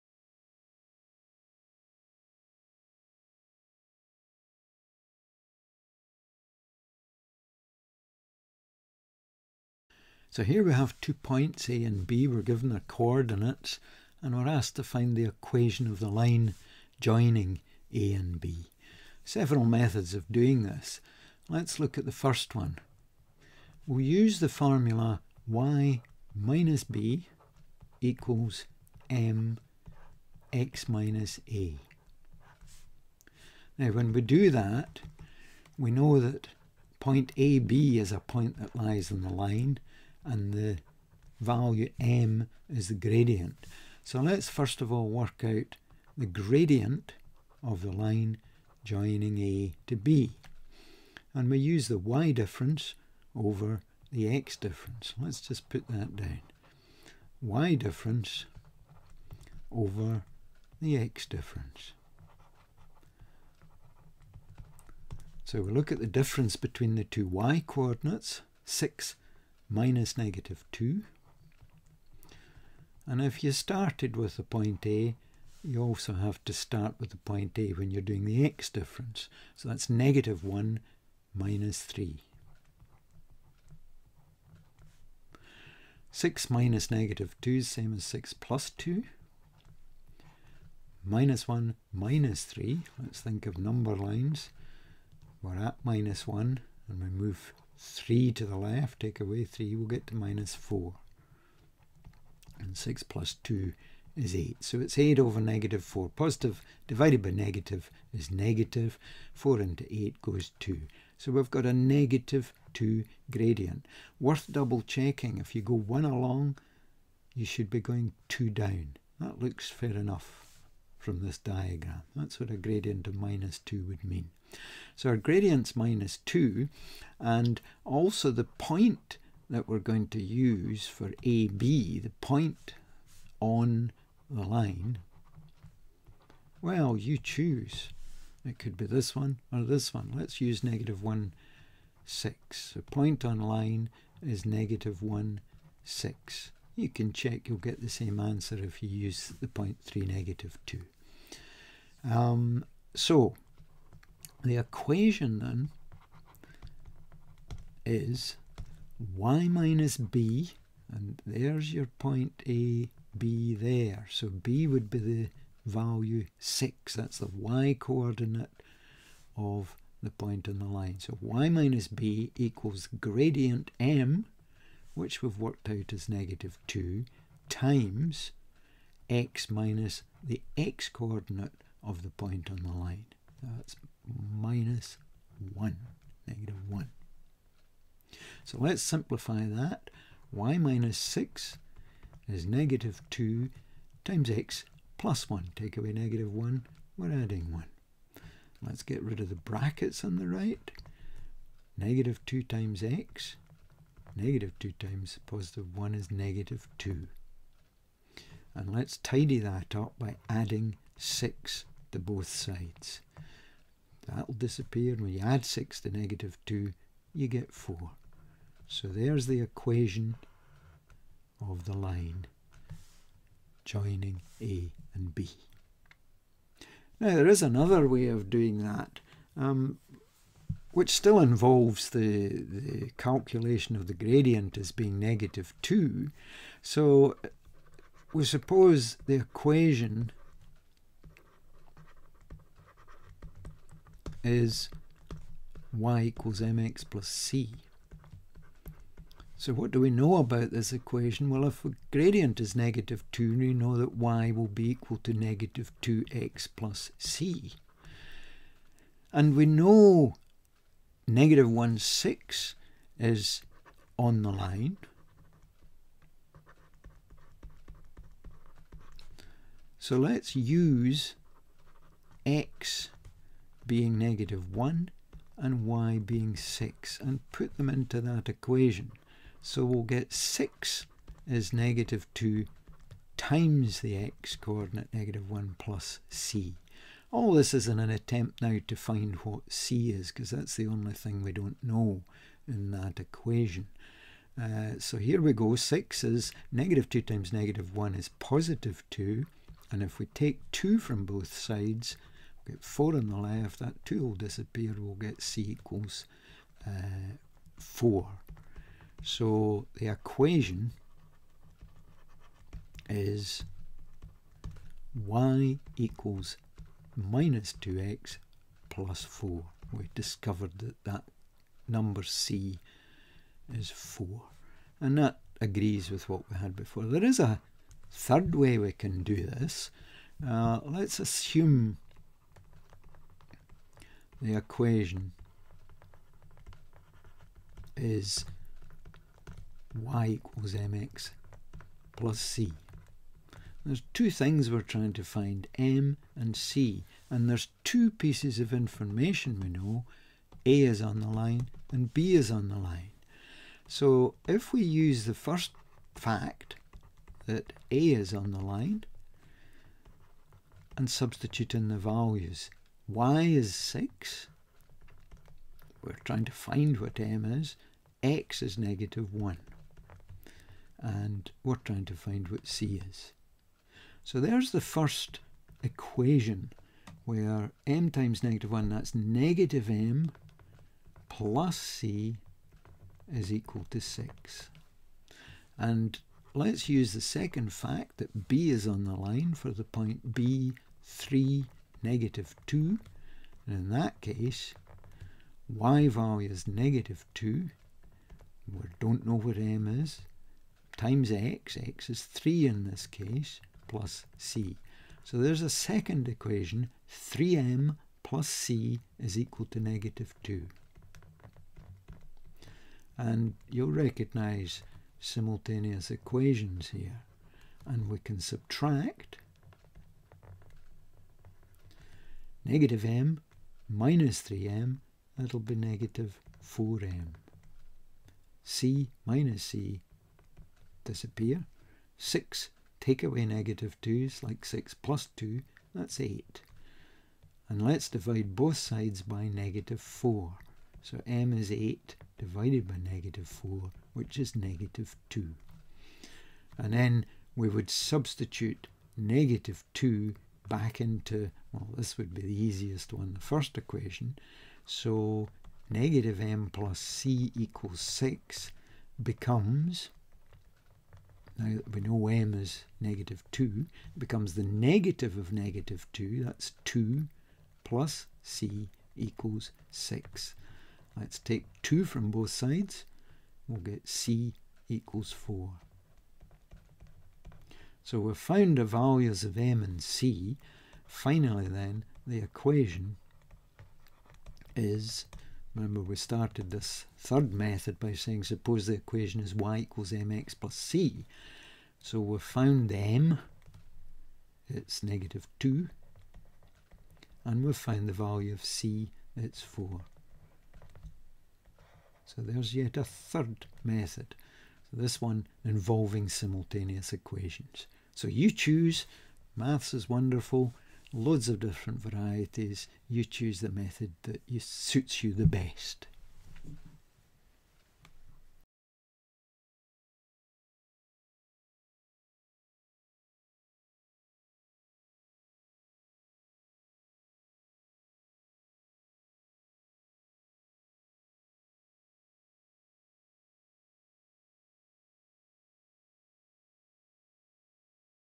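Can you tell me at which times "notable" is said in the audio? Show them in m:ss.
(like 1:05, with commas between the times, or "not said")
not said.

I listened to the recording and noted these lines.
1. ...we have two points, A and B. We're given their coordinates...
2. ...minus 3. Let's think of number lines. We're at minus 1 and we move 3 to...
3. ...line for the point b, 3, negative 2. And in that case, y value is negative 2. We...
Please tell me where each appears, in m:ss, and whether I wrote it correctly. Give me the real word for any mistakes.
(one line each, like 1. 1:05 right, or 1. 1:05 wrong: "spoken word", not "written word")
1. 0:10 right
2. 1:31 right
3. 6:28 right.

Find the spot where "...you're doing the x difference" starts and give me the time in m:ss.
1:17.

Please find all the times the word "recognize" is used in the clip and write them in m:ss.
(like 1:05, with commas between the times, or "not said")
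6:53.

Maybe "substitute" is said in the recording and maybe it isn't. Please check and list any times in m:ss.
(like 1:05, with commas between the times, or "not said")
6:00, 7:27.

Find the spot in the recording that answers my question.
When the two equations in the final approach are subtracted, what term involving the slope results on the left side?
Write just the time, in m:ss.
7:05.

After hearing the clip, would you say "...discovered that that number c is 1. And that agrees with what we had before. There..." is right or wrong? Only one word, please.
wrong.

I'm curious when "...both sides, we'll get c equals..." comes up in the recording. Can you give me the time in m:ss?
7:52.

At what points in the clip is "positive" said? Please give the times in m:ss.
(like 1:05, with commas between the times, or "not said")
1:46, 3:25, 4:58.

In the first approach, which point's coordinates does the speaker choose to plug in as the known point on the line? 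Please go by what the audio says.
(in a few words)
(-1, 6).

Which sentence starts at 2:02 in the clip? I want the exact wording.
That's what a gradient of minus 2 would mean.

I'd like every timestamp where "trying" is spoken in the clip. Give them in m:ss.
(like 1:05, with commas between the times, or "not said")
5:44, 6:06, 6:11.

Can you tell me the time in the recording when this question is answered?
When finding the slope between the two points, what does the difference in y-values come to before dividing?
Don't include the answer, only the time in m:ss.
1:42.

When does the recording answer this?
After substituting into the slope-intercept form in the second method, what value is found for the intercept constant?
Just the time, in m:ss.
5:05.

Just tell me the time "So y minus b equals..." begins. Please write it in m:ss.
2:50.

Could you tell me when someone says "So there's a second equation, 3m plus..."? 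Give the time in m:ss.
6:45.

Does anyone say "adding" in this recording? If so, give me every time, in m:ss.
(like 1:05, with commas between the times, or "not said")
3:17, 3:30.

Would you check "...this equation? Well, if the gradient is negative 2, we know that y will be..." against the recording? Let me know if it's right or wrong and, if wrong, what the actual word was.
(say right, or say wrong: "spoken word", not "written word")
right.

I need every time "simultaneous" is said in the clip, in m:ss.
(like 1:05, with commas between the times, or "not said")
6:54, 8:26.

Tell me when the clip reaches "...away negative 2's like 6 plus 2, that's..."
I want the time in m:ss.
7:13.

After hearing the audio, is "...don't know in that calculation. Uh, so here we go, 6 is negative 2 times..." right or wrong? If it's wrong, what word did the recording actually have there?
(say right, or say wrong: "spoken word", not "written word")
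wrong: "equation", not "calculation".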